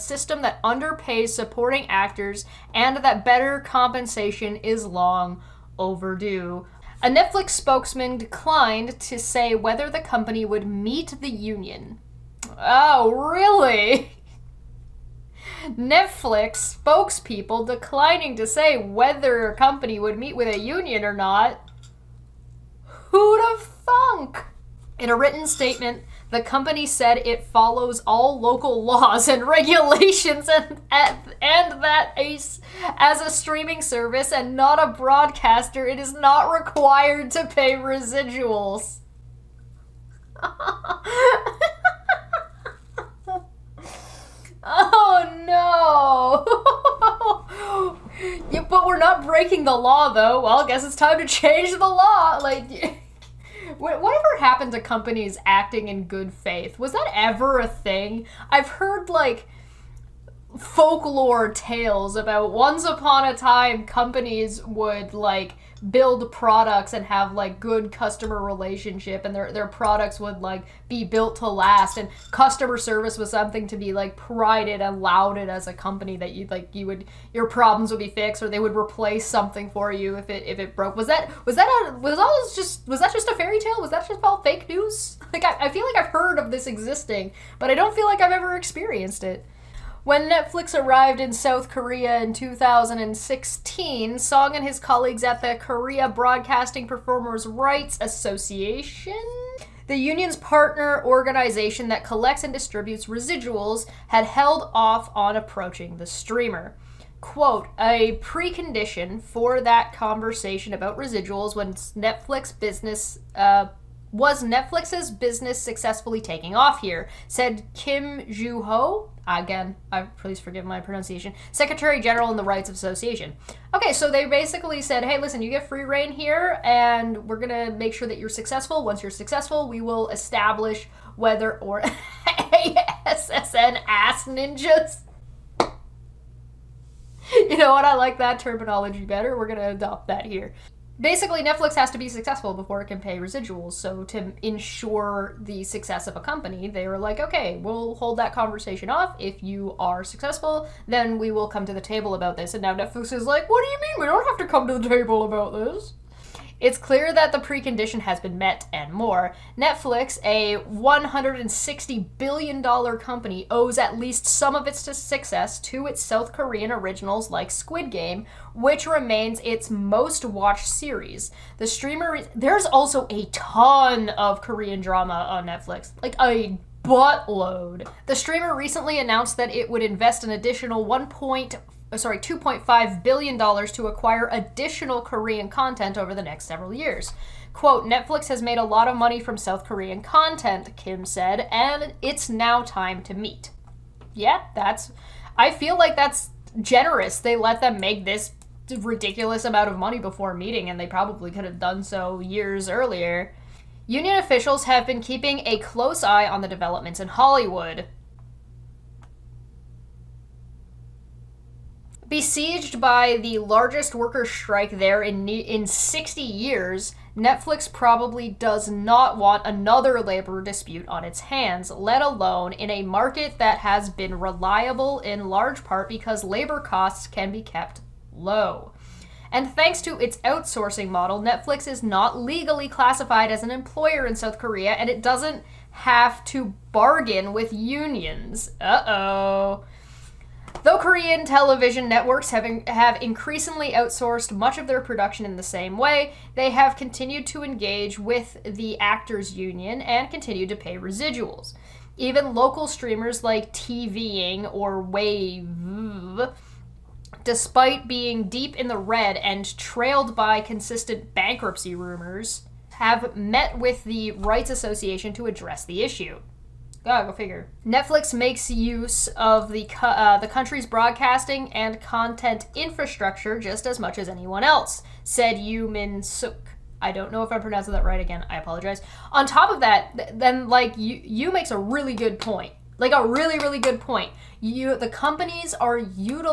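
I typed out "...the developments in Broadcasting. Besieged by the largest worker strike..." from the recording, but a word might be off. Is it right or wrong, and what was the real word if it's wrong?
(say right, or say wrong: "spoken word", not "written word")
wrong: "Hollywood", not "Broadcasting".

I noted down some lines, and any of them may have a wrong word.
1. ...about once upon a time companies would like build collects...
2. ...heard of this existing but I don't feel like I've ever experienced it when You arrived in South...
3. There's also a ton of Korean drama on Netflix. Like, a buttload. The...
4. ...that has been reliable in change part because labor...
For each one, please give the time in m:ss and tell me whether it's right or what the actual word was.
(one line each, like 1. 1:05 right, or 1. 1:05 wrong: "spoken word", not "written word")
1. 1:02 wrong: "products", not "collects"
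2. 1:26 wrong: "Netflix", not "You"
3. 2:52 right
4. 3:43 wrong: "large", not "change".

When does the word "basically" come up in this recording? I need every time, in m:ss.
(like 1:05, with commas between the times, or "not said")
2:04, 2:21.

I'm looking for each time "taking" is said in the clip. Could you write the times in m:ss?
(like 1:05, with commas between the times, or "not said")
1:56.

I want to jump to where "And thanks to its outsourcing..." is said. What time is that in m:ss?
3:49.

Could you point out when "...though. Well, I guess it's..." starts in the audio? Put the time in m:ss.
0:50.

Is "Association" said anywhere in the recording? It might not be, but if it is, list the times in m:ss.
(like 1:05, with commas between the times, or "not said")
1:38, 2:02, 4:24.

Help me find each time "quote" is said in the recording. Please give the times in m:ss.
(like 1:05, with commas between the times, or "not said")
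1:47, 3:07.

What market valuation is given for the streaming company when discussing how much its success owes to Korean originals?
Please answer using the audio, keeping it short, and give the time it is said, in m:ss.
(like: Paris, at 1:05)
$160 billion, at 2:40.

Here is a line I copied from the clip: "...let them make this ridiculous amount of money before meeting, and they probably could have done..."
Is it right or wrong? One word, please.
right.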